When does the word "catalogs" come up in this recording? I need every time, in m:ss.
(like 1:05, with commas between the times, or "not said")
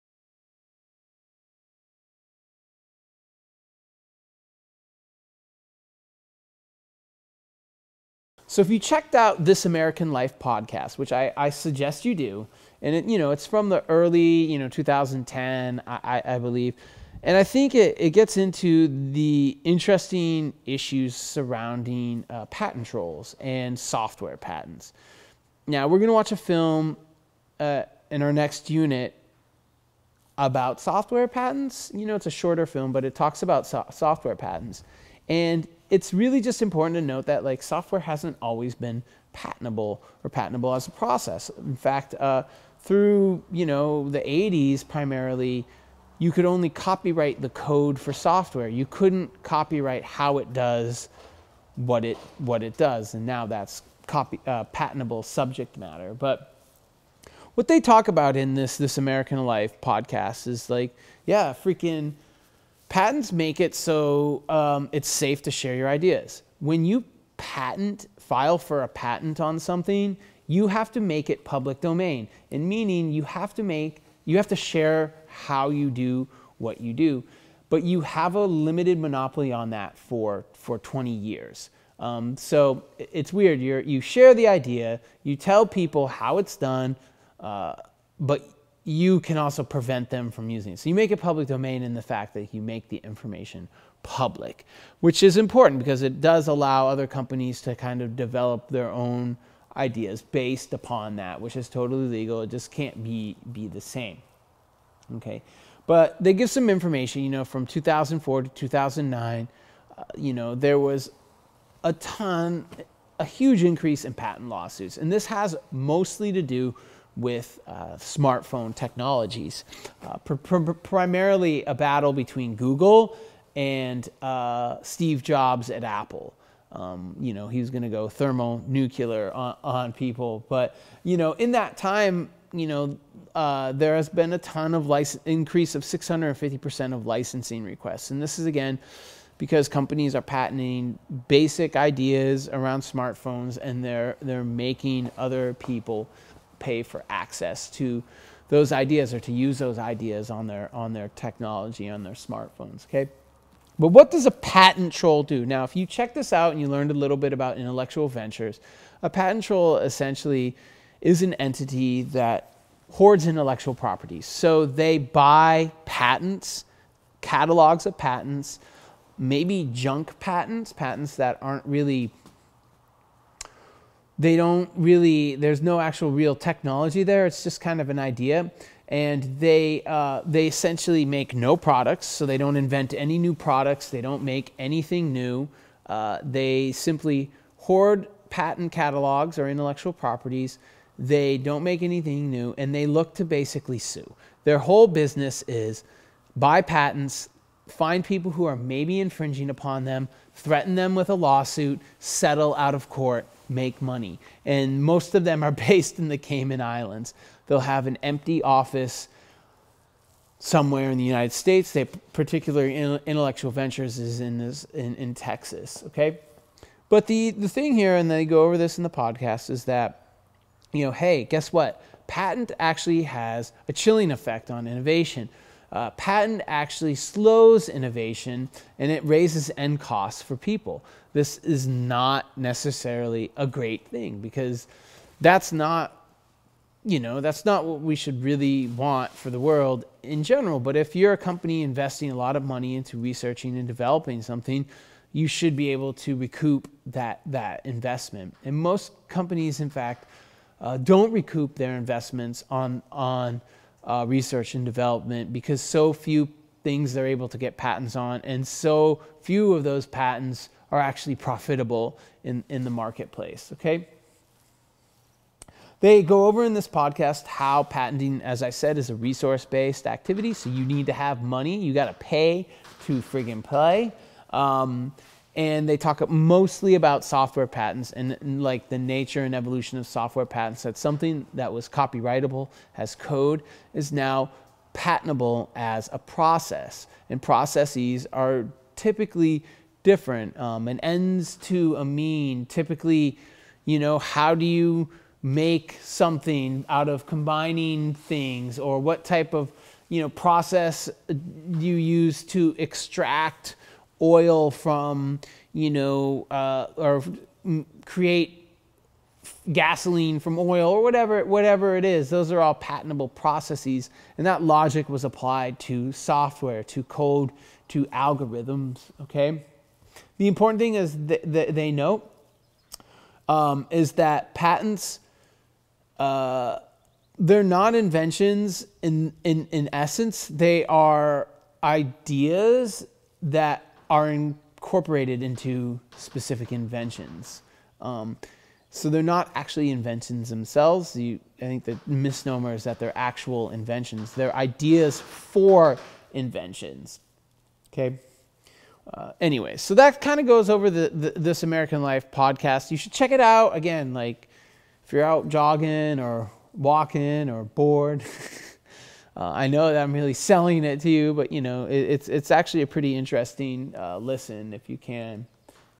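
2:47, 3:08.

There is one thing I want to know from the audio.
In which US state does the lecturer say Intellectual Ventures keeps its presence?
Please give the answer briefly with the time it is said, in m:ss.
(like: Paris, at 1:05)
Texas, at 3:35.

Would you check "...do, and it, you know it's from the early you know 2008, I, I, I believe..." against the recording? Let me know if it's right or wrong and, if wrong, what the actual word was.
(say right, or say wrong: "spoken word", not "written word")
wrong: "2010", not "2008".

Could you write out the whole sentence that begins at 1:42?
It just can't be be the same.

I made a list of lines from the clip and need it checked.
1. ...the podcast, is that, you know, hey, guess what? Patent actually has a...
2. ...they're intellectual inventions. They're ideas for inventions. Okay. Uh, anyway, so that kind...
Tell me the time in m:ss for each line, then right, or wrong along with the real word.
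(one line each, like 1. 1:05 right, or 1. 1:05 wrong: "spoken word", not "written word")
1. 3:38 right
2. 5:42 wrong: "actual", not "intellectual".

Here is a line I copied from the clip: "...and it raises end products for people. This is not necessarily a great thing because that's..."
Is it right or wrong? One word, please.
wrong.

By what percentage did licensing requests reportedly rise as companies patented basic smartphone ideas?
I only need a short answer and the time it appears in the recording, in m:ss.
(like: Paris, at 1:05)
650%, at 2:15.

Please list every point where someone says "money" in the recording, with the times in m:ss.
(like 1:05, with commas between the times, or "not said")
3:23, 4:02, 4:31.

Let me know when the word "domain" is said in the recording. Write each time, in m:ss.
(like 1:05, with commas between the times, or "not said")
1:11, 1:31.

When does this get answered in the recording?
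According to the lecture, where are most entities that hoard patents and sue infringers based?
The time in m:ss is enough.
3:26.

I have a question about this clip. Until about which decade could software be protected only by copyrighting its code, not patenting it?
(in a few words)
the 80s.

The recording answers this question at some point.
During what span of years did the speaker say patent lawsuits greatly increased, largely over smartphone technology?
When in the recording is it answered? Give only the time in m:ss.
1:47.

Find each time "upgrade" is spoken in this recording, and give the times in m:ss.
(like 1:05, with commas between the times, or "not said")
not said.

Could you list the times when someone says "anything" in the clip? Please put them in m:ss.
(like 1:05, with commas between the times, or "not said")
3:04, 3:11.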